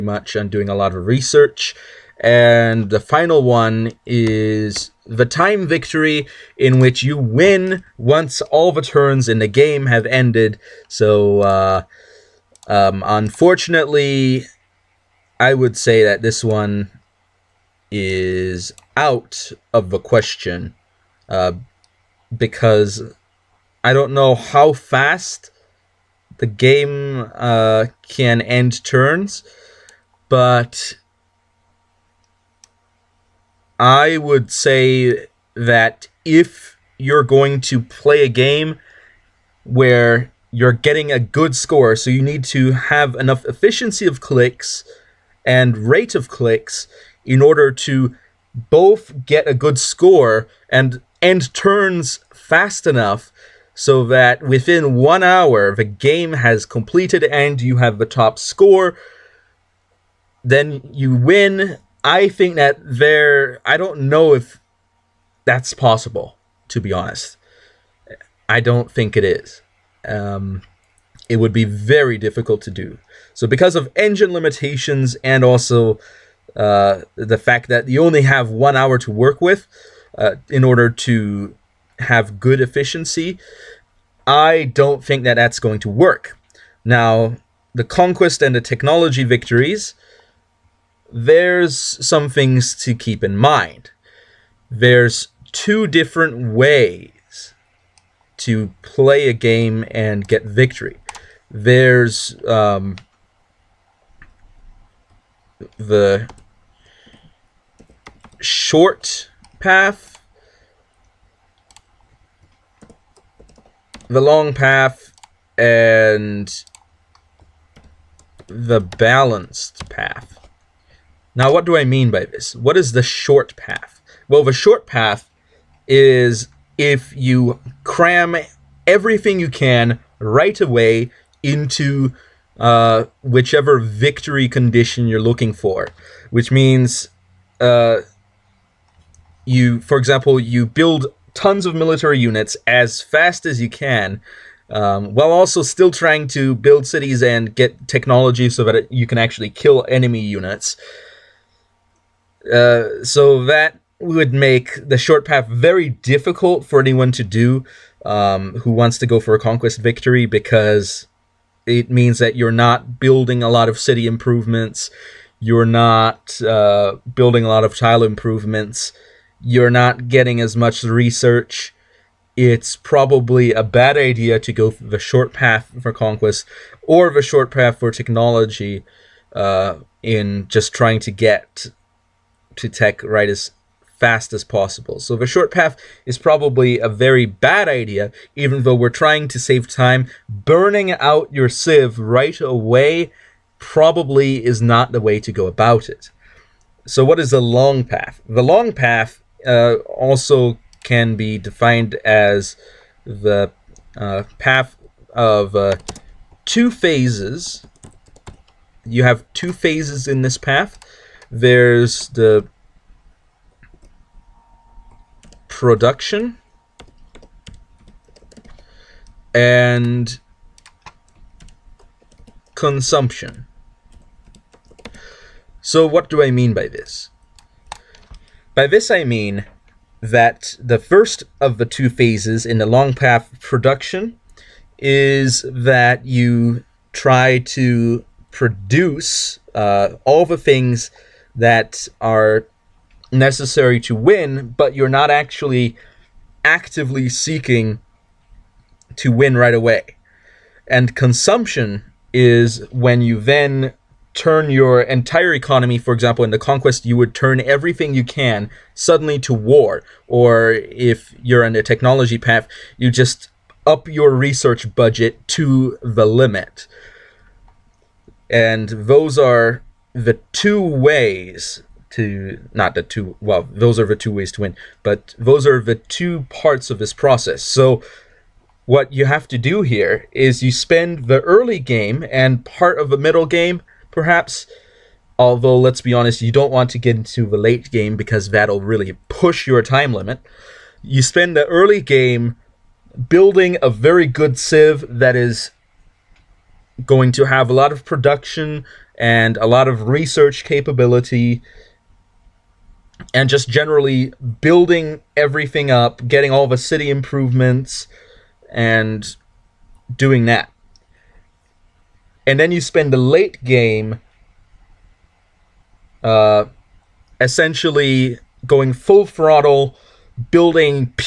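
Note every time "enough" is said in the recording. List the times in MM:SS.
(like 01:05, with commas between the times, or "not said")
00:43, 00:52.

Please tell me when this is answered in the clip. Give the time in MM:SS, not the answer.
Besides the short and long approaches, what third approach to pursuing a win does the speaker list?
01:58.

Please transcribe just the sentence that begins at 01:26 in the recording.
Now, the conquest and the technology victories, there's some things to keep in mind.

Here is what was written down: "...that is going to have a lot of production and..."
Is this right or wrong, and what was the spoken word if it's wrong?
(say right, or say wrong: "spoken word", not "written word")
right.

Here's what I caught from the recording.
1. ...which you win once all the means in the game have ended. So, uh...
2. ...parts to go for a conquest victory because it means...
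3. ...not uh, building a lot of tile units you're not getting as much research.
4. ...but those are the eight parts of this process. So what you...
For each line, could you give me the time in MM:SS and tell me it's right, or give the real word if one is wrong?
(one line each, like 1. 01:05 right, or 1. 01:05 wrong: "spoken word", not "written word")
1. 00:06 wrong: "turns", not "means"
2. 02:38 wrong: "wants", not "parts"
3. 02:45 wrong: "improvements", not "units"
4. 04:34 wrong: "two", not "eight".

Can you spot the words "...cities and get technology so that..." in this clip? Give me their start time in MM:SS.
02:26.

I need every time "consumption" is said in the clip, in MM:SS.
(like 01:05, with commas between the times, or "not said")
03:42, 04:10.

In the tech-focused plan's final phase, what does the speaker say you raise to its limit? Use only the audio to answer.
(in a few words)
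research budget.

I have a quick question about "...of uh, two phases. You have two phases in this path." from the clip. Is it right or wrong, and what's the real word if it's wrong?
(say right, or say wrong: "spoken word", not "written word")
right.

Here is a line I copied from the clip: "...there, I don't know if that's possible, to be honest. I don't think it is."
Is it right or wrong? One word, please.
right.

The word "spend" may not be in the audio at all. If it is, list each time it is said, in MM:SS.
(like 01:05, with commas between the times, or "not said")
04:40, 04:51, 05:12.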